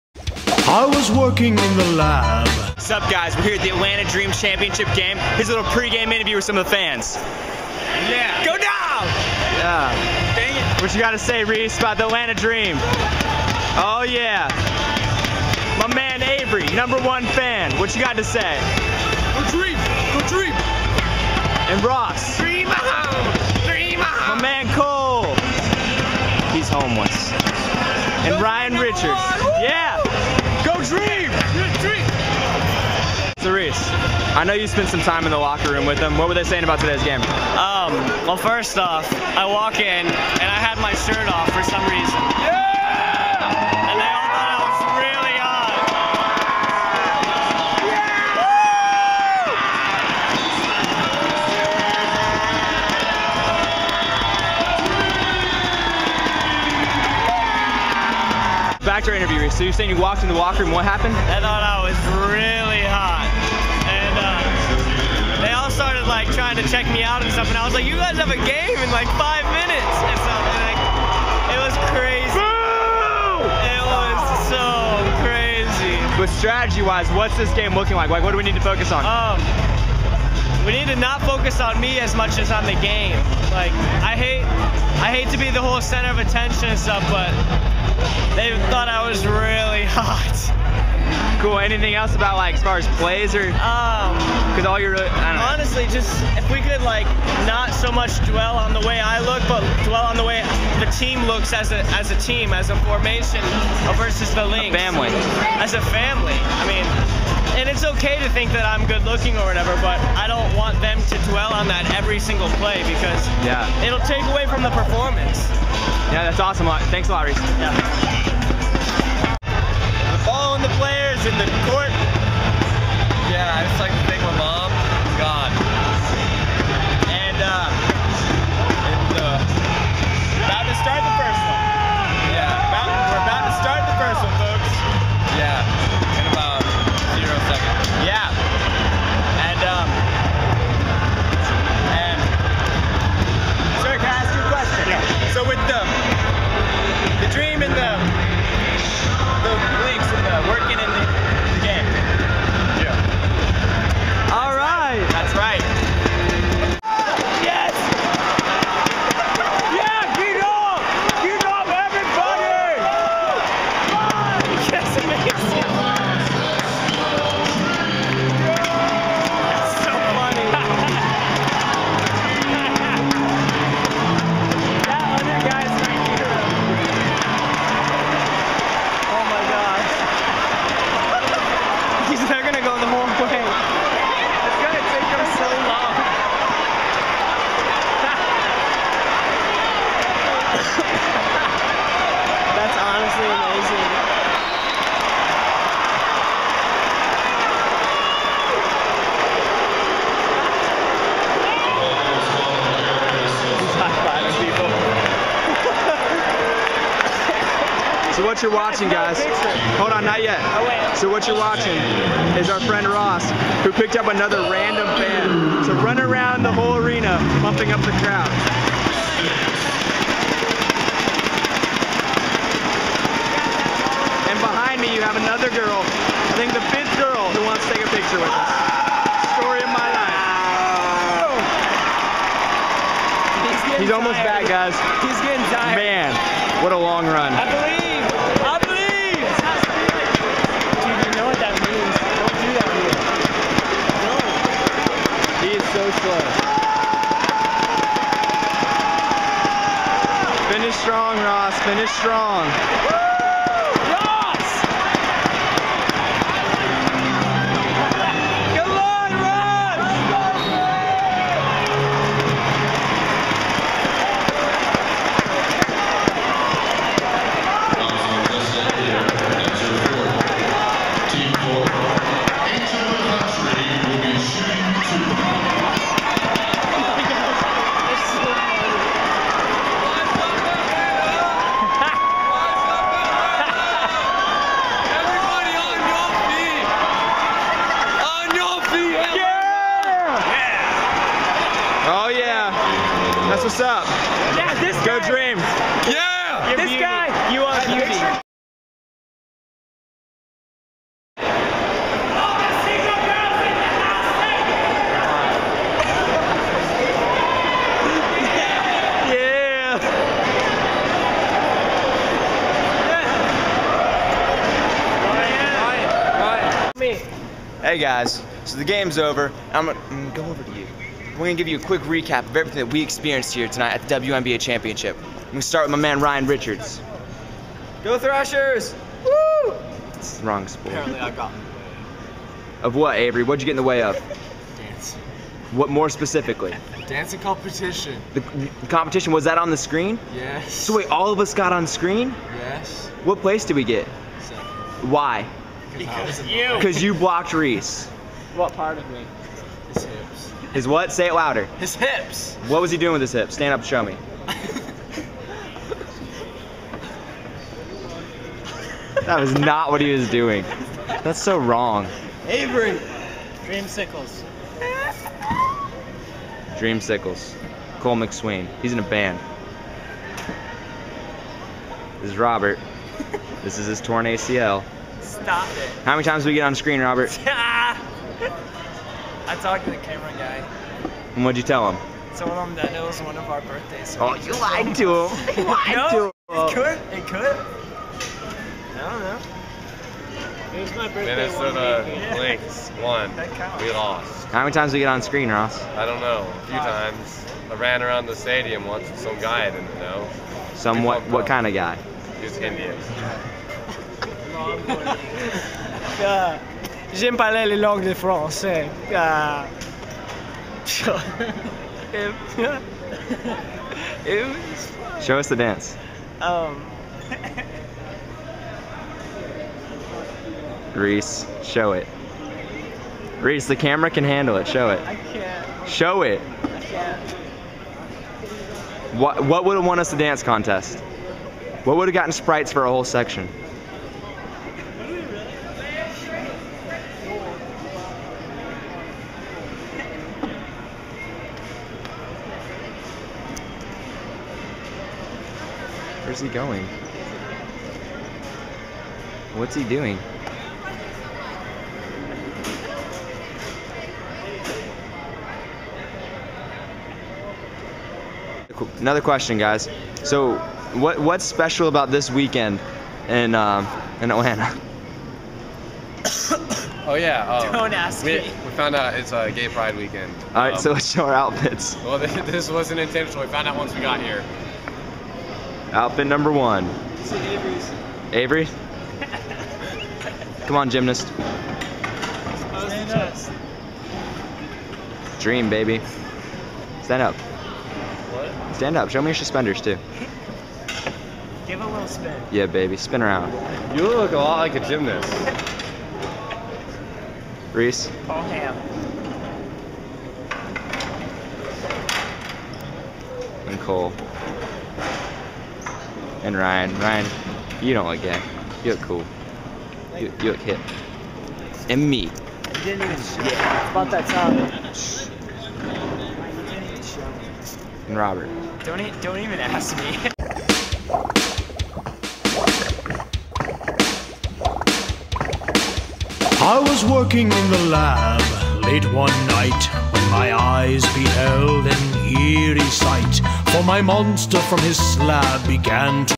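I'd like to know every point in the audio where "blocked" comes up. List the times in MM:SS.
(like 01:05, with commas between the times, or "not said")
05:46.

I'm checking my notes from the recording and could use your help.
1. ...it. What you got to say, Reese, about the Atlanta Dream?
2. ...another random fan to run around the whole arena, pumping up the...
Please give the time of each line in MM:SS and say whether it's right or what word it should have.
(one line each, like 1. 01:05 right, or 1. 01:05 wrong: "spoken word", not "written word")
1. 00:10 right
2. 03:34 right.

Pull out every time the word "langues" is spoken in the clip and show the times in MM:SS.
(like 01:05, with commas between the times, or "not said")
06:47.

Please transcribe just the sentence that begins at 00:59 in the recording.
So you're saying you walked in the locker room.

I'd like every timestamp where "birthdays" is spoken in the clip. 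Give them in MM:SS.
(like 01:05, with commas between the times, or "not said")
06:23, 06:30.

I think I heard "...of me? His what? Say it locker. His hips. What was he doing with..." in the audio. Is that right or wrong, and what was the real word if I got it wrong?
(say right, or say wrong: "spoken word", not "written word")
wrong: "louder", not "locker".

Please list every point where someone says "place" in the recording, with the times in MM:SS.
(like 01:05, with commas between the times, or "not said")
05:43.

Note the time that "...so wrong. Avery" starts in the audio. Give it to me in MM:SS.
06:01.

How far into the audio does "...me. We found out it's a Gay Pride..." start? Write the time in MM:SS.
07:48.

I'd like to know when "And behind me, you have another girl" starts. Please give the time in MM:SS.
03:44.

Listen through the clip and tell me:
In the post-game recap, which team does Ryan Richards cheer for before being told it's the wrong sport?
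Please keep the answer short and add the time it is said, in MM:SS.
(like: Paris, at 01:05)
Thrashers, at 05:27.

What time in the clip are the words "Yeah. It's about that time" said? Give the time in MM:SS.
08:33.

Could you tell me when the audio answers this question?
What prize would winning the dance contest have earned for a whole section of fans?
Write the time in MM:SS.
07:12.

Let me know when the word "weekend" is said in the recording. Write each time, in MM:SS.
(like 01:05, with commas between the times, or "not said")
07:42, 07:49.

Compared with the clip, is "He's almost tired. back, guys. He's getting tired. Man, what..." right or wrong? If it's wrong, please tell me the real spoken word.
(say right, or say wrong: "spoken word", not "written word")
right.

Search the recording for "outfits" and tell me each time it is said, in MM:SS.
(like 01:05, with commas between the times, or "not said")
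07:51, 07:55.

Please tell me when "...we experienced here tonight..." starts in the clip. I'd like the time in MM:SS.
05:22.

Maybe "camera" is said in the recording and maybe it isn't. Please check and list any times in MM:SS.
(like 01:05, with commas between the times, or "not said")
06:19, 07:03.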